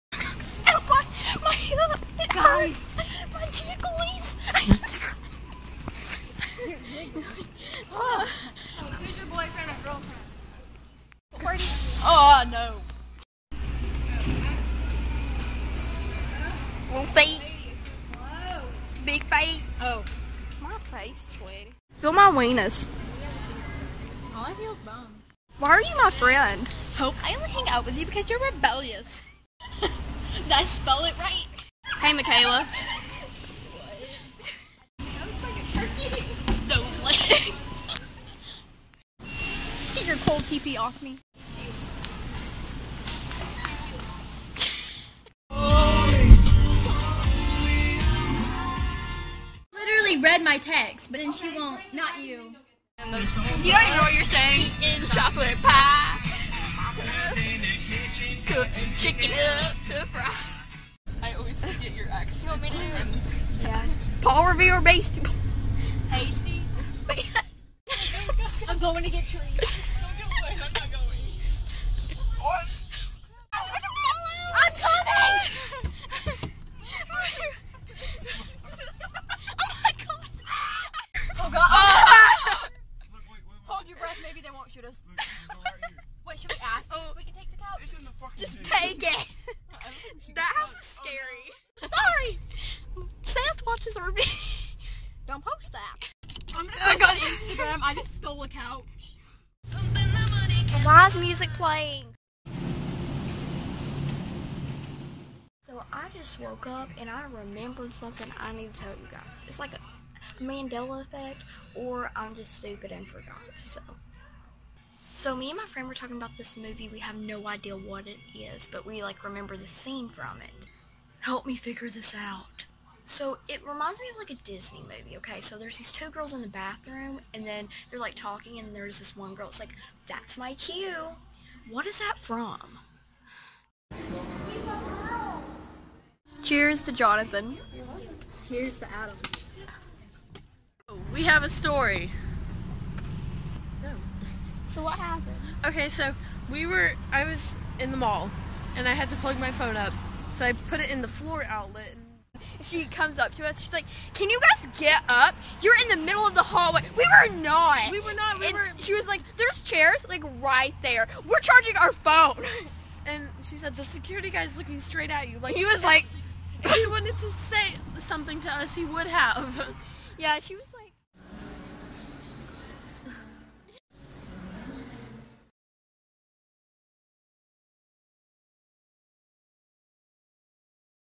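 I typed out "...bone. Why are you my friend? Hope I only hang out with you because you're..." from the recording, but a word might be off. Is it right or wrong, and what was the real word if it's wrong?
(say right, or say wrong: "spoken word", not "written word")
right.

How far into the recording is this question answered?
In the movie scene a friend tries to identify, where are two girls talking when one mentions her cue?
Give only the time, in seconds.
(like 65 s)
126 s.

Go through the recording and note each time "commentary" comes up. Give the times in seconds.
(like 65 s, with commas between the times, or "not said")
not said.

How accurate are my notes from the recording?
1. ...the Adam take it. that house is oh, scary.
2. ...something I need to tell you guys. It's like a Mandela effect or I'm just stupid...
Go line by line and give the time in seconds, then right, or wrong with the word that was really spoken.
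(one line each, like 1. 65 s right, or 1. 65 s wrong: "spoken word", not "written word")
1. 88 s wrong: "Just", not "Adam"
2. 107 s right.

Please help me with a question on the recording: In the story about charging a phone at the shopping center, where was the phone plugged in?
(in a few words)
floor outlet.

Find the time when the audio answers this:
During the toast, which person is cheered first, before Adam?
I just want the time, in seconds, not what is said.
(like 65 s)
136 s.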